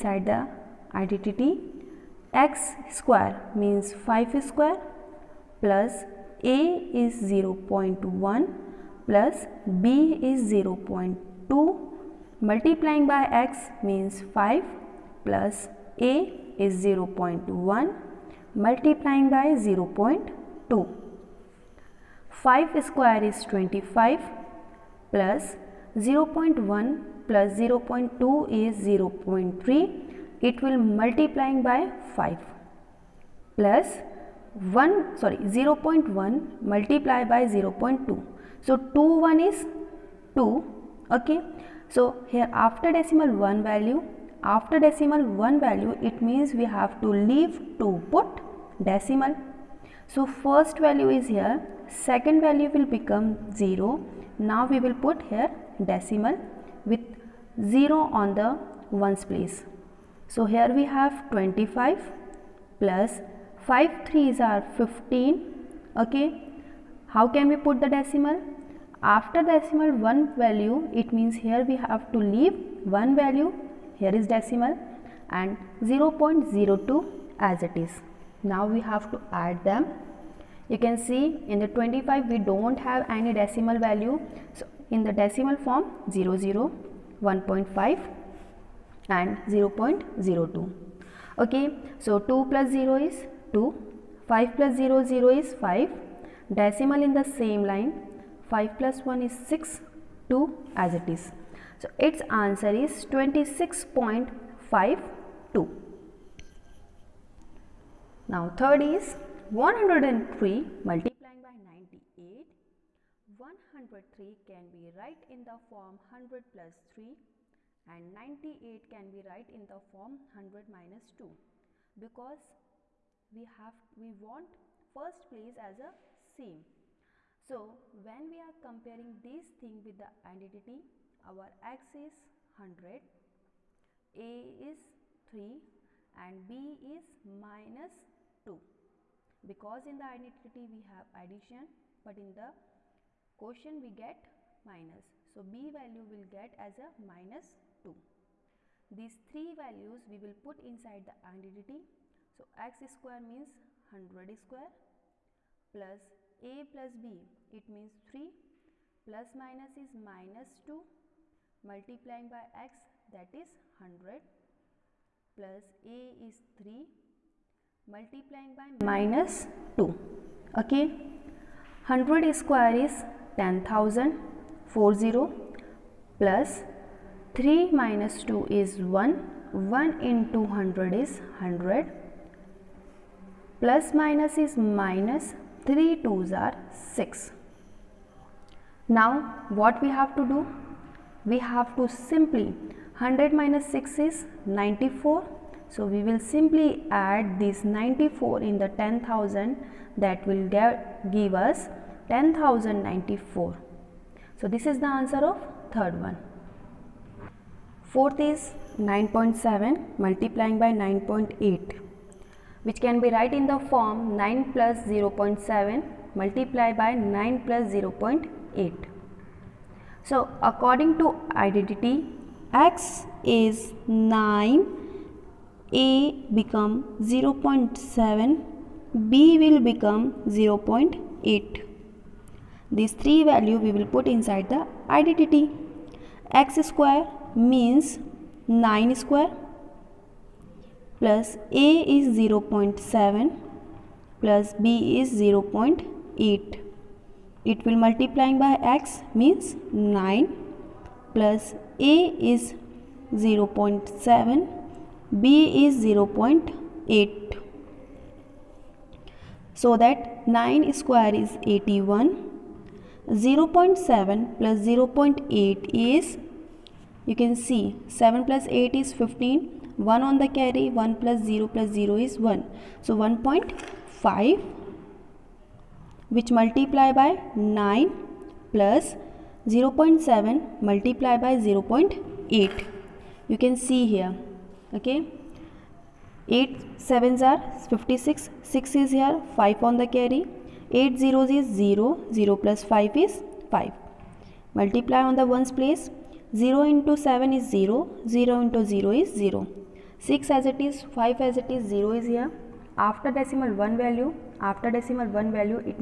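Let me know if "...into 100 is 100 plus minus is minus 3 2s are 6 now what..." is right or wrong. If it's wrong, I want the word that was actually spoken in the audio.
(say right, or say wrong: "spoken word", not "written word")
right.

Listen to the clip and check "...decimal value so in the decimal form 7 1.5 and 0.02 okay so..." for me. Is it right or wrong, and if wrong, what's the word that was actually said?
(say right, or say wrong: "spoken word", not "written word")
wrong: "0", not "7".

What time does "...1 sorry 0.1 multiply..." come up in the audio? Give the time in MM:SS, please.
00:34.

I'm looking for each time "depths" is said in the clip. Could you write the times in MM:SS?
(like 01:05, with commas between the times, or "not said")
not said.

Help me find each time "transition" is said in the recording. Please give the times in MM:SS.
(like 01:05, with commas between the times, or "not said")
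not said.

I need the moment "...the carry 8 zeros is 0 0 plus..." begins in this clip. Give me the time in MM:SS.
04:49.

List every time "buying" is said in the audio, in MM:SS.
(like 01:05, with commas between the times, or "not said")
not said.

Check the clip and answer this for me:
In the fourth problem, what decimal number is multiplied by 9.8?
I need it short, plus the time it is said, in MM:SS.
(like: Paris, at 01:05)
9.7, at 03:28.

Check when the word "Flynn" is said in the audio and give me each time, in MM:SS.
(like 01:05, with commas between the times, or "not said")
not said.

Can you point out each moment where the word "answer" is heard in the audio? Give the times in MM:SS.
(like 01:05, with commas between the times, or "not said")
01:42, 03:24.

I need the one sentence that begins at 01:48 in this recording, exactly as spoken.
Now third is 103 multiplying by 98.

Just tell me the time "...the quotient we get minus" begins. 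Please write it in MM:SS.
02:22.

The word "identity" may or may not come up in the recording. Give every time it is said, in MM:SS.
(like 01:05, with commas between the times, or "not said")
00:00, 02:10, 02:20, 02:31, 03:41, 03:54.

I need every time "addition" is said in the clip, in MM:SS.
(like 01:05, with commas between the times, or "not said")
02:21.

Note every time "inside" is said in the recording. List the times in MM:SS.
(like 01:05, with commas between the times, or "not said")
02:30, 03:54.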